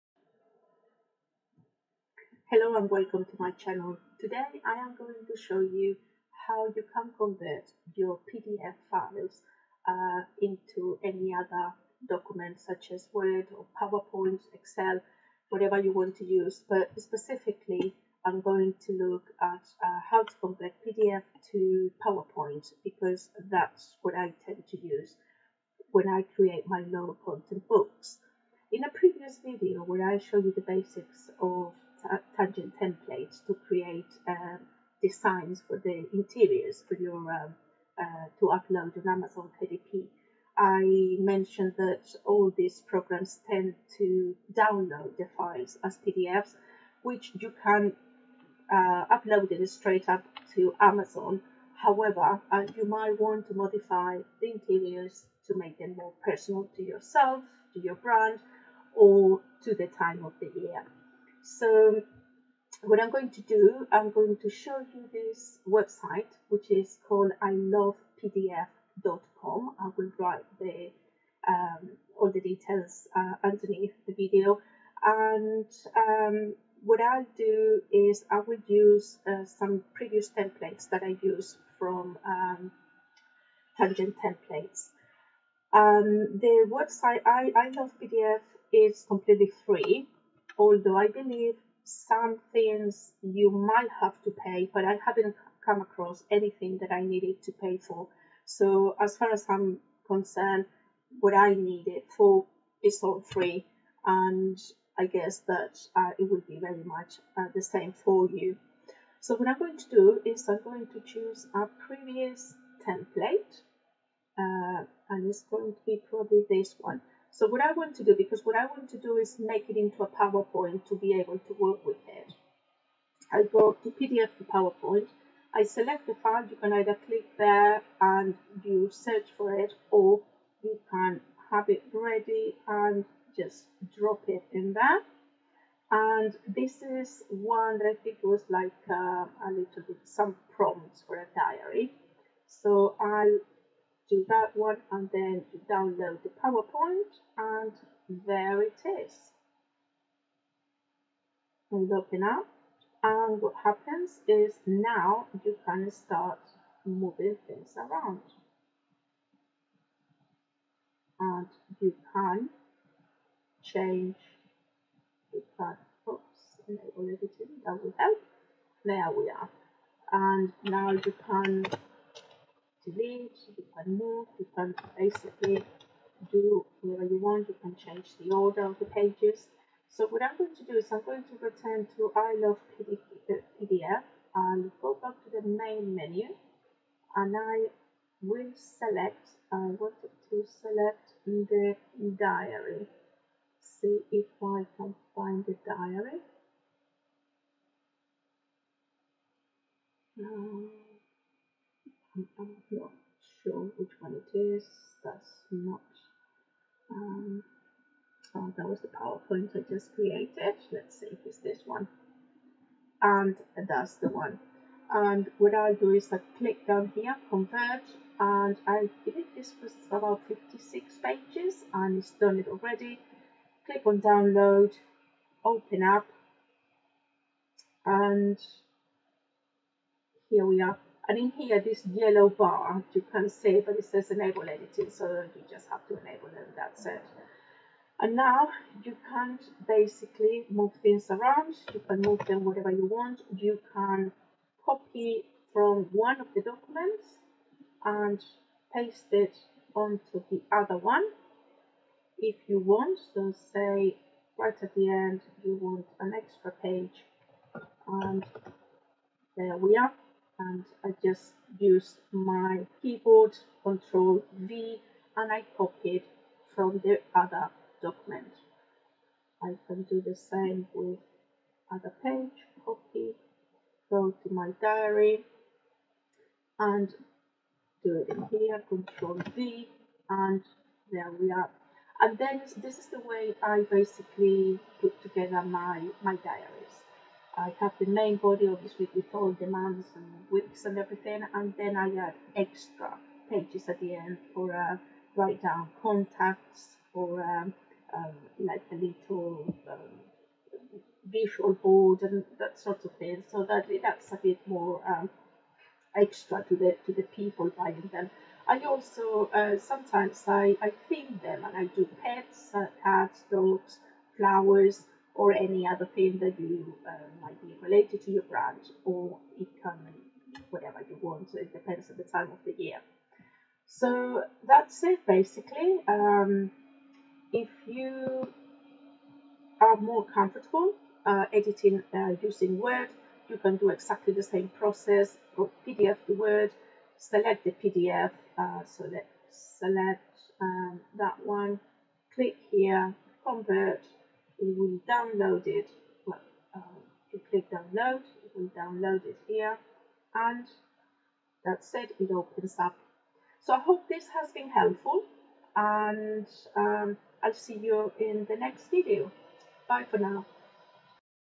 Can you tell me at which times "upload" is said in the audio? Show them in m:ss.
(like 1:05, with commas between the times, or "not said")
0:38, 0:49.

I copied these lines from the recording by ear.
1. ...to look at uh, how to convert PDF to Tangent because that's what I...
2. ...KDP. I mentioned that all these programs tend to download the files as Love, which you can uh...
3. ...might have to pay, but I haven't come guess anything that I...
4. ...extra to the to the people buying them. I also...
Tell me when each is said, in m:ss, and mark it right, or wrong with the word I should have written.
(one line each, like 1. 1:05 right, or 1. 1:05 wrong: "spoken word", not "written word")
1. 0:18 wrong: "PowerPoint", not "Tangent"
2. 0:39 wrong: "PDFs", not "Love"
3. 1:33 wrong: "across", not "guess"
4. 5:05 right.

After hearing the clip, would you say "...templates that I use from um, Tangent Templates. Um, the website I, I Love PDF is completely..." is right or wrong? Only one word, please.
right.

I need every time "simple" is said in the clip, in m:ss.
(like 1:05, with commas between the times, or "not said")
not said.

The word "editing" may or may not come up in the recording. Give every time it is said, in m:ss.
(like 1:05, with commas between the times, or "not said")
2:47, 3:54, 5:31.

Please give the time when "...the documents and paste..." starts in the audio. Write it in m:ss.
4:06.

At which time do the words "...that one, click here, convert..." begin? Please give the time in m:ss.
5:40.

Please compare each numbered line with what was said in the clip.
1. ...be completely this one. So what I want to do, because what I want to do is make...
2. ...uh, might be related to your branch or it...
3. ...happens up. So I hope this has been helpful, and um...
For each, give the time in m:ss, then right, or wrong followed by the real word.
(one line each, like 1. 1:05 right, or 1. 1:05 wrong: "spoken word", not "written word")
1. 1:55 wrong: "probably", not "completely"
2. 5:16 right
3. 5:52 wrong: "opens", not "happens".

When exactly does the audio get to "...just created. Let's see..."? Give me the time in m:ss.
3:29.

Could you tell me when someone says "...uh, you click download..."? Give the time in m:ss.
5:46.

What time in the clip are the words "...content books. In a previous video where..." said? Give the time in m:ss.
0:27.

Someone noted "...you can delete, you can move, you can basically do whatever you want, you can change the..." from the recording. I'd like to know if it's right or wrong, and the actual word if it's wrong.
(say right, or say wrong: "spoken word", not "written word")
right.